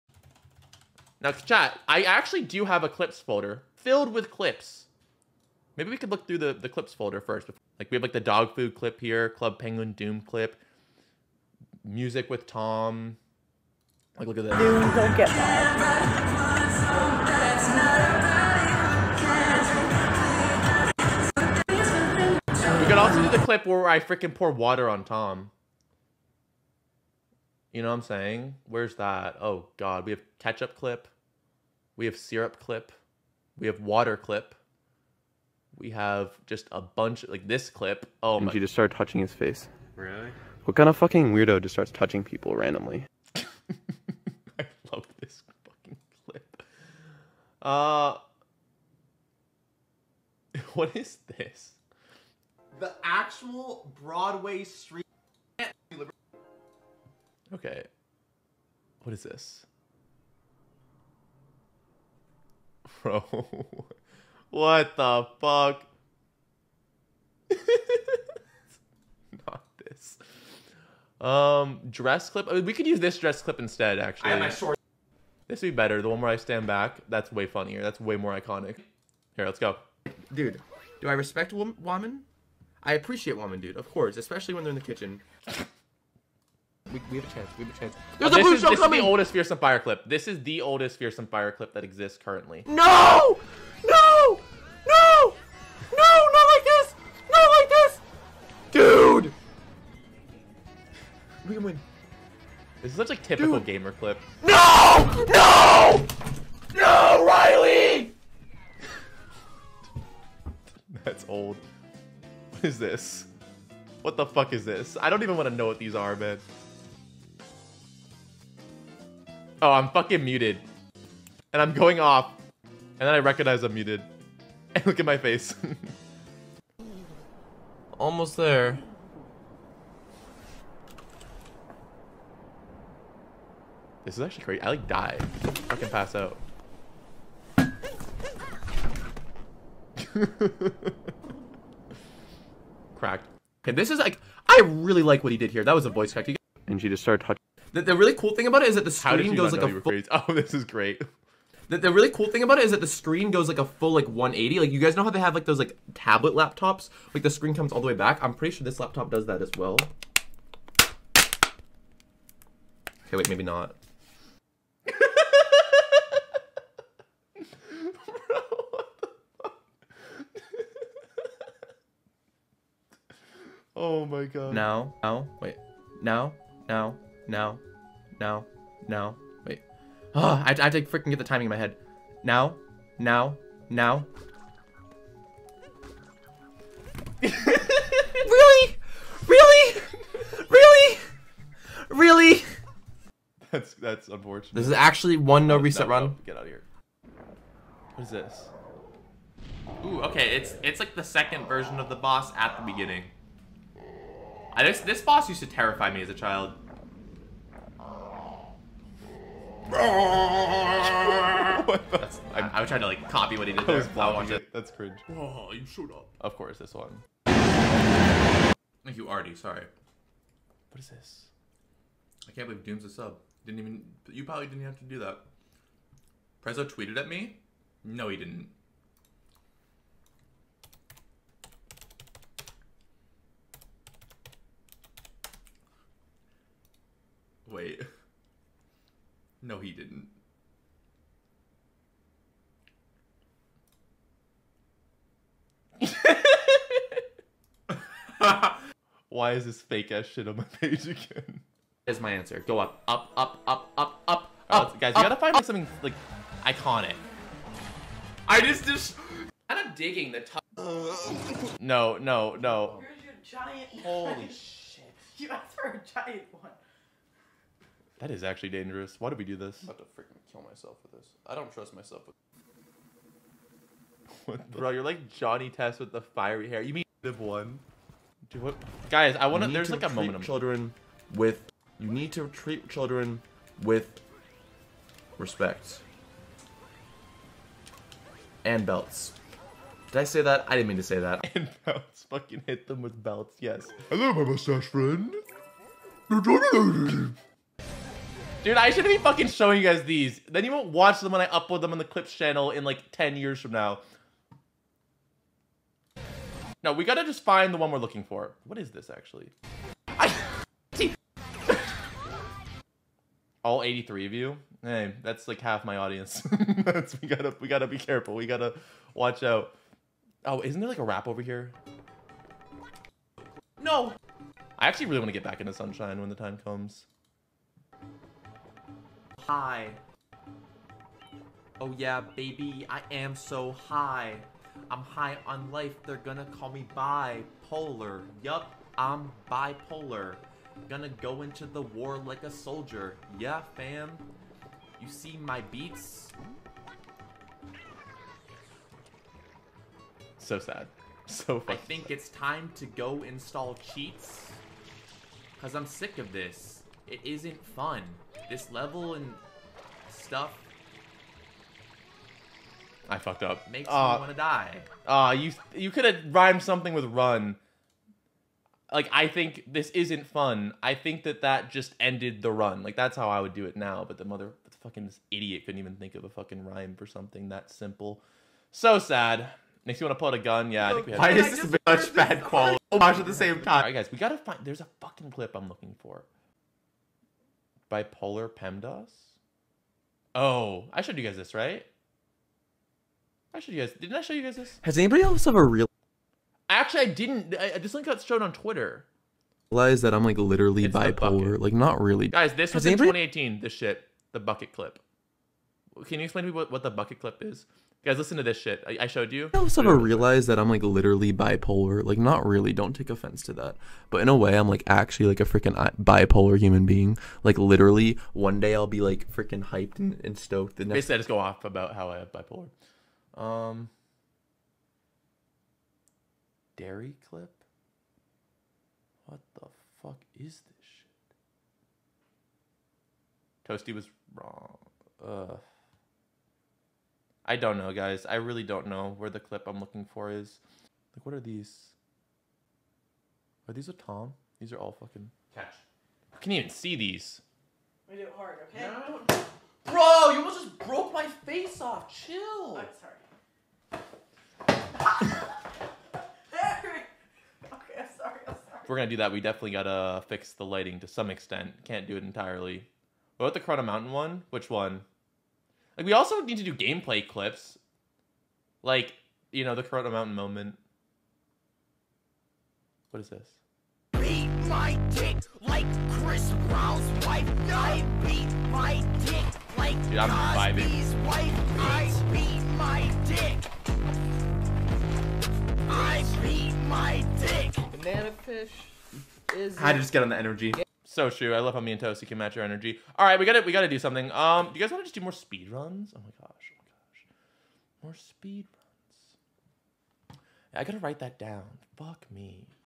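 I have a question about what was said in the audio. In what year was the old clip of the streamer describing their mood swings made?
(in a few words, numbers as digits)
2018.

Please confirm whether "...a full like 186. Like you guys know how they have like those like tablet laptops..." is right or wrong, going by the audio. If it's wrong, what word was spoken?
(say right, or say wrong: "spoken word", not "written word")
wrong: "180", not "186".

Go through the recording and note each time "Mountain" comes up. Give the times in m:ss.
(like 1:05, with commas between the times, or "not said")
7:43, 7:49.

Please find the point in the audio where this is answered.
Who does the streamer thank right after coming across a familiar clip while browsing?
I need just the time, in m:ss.
3:39.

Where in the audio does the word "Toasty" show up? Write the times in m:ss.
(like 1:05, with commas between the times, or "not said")
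7:13, 8:11.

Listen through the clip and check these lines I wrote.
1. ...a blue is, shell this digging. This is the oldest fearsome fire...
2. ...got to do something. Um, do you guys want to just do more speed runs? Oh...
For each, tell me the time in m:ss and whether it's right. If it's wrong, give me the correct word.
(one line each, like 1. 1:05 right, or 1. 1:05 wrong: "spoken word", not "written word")
1. 1:28 wrong: "coming", not "digging"
2. 8:13 right.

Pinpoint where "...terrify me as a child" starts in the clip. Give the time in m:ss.
3:25.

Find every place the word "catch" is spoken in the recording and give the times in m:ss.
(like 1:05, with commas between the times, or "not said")
0:30, 7:25.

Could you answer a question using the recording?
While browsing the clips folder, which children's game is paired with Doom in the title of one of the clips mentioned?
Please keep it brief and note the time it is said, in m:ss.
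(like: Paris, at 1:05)
Club Penguin, at 0:09.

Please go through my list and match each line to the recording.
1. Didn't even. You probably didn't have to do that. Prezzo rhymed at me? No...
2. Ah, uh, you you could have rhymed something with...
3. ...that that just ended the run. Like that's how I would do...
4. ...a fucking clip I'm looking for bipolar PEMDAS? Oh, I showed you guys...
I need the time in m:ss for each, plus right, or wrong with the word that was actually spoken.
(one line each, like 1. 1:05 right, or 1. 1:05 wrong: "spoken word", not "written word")
1. 3:43 wrong: "tweeted", not "rhymed"
2. 6:04 right
3. 6:11 right
4. 6:24 right.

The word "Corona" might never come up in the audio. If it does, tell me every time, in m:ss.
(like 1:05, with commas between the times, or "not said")
7:43, 7:49.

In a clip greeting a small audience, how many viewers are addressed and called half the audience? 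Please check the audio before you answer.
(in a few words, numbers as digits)
83.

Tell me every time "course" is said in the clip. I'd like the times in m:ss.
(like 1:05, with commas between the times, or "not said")
1:23, 3:36.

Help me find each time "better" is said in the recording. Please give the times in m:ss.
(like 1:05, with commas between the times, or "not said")
1:15.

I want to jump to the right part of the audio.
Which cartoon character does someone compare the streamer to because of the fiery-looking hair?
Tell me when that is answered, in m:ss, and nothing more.
4:35.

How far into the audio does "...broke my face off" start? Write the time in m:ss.
7:30.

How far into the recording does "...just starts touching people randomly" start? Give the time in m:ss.
0:41.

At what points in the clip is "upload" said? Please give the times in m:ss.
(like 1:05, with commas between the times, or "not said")
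5:01.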